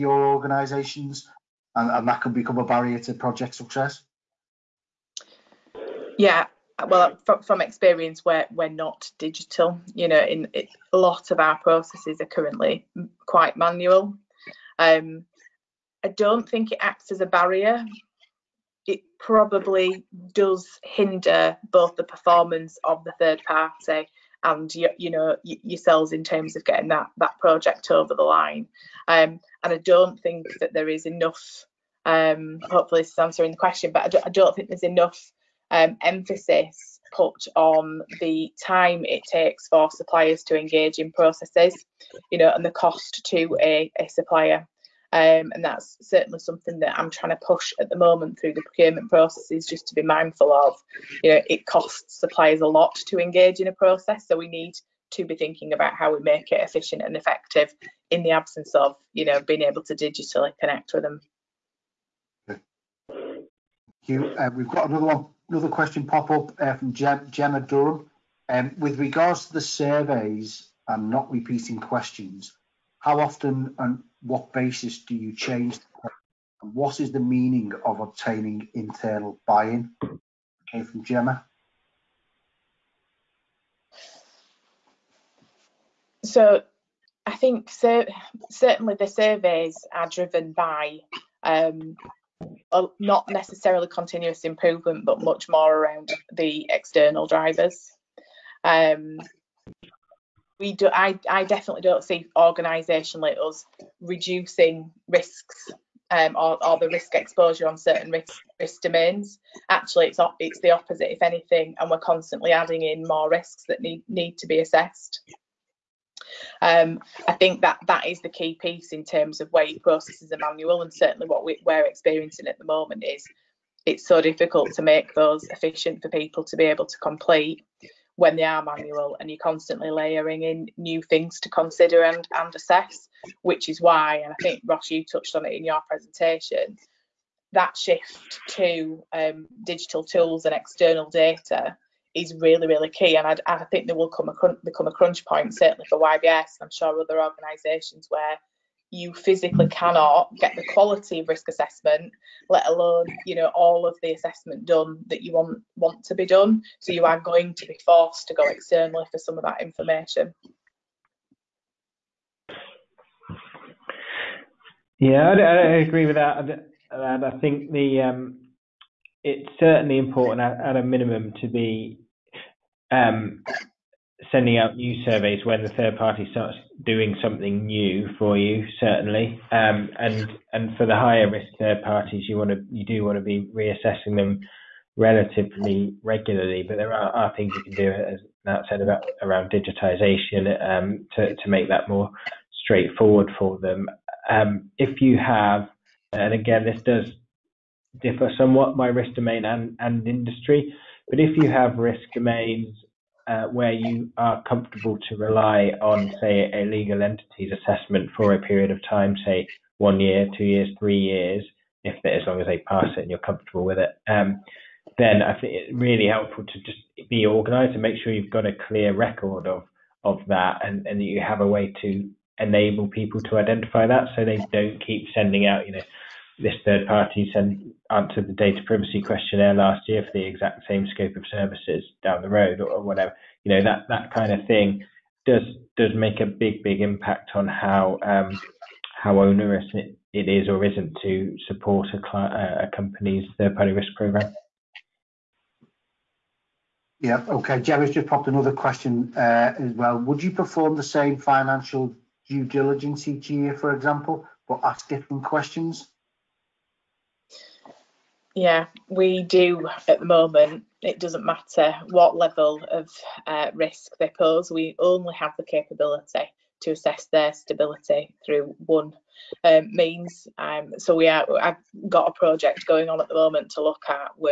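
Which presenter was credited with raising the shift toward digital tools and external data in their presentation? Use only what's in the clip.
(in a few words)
Ross.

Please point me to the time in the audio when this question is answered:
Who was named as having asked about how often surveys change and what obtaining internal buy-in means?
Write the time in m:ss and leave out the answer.
1:07.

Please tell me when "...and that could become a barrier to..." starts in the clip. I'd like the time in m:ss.
0:01.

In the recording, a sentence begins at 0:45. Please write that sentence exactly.
Um, and that's certainly something that I'm trying to push at the moment through the procurement processes, just to be mindful of.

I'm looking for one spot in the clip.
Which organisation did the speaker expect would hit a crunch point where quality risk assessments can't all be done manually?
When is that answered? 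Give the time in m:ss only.
2:25.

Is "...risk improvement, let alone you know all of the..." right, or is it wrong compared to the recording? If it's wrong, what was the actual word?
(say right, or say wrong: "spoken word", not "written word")
wrong: "assessment", not "improvement".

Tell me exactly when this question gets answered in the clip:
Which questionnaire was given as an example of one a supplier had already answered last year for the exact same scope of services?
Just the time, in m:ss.
3:48.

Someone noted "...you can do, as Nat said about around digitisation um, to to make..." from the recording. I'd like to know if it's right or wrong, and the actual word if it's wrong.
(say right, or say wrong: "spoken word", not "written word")
right.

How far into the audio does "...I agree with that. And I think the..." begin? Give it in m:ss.
2:45.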